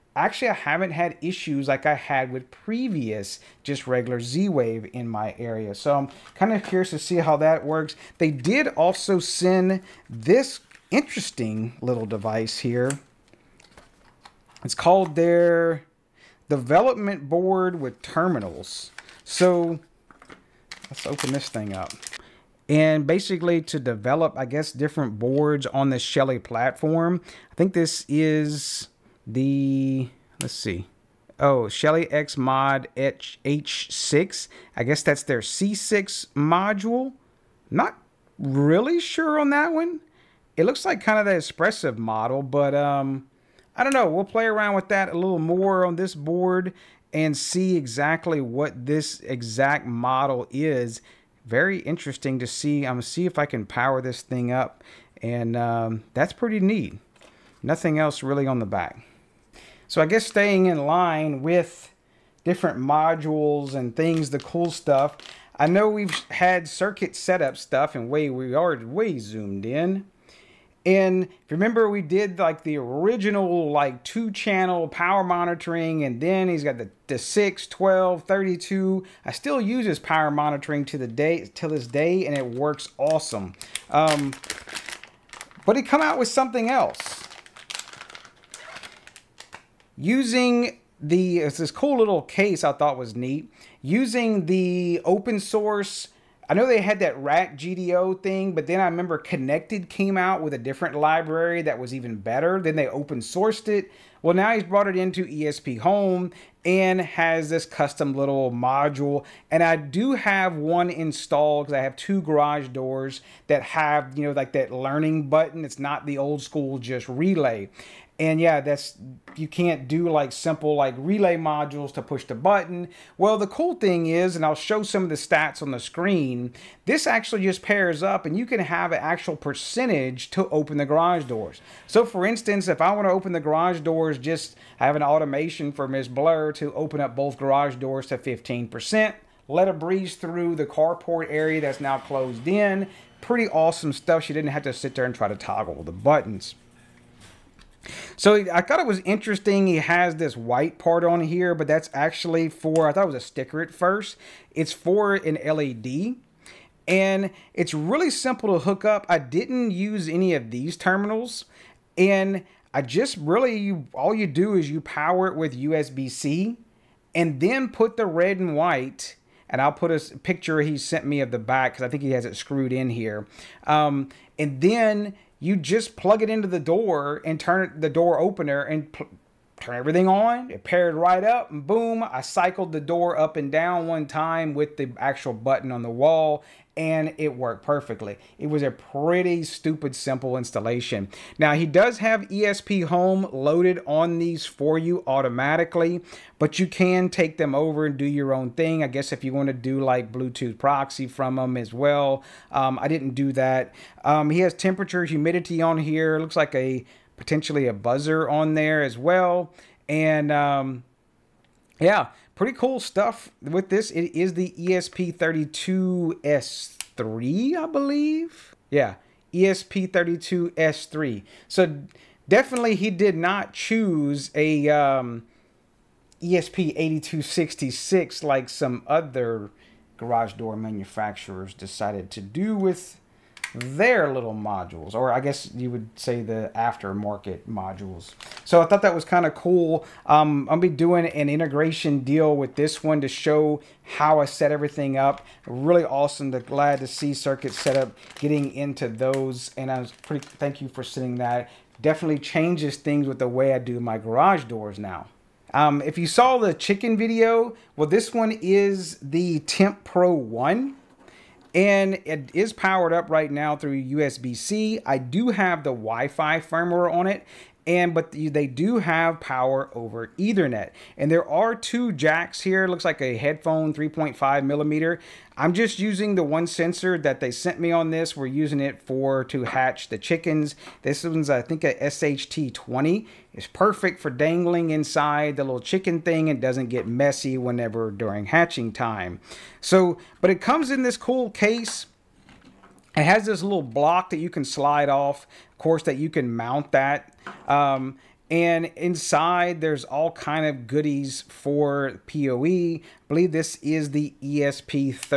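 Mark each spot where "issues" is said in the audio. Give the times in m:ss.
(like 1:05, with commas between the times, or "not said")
0:01.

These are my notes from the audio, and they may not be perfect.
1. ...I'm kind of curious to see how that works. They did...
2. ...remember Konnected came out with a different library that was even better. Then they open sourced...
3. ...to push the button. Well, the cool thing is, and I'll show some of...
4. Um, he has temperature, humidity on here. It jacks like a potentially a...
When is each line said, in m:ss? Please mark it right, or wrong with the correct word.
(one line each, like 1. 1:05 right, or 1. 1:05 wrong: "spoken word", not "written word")
1. 0:05 right
2. 1:38 right
3. 2:01 right
4. 3:24 wrong: "looks", not "jacks".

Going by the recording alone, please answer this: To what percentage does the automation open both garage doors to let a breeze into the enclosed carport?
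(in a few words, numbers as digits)
15%.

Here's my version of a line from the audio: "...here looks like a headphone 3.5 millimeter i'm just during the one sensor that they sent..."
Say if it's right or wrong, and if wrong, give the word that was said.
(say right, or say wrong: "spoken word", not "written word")
wrong: "using", not "during".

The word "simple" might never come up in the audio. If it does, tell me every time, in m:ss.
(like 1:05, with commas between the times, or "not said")
2:00, 2:38, 3:09.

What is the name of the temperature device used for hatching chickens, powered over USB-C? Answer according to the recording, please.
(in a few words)
Temp Pro 1.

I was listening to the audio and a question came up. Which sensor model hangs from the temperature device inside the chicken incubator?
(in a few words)
SHT20.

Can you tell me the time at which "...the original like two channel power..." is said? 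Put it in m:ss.
1:12.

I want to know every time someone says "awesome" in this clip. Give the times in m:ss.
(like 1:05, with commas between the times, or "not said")
1:22, 2:23, 4:05.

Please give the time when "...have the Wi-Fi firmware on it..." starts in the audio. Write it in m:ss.
4:25.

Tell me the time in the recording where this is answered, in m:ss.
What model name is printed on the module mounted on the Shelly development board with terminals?
0:31.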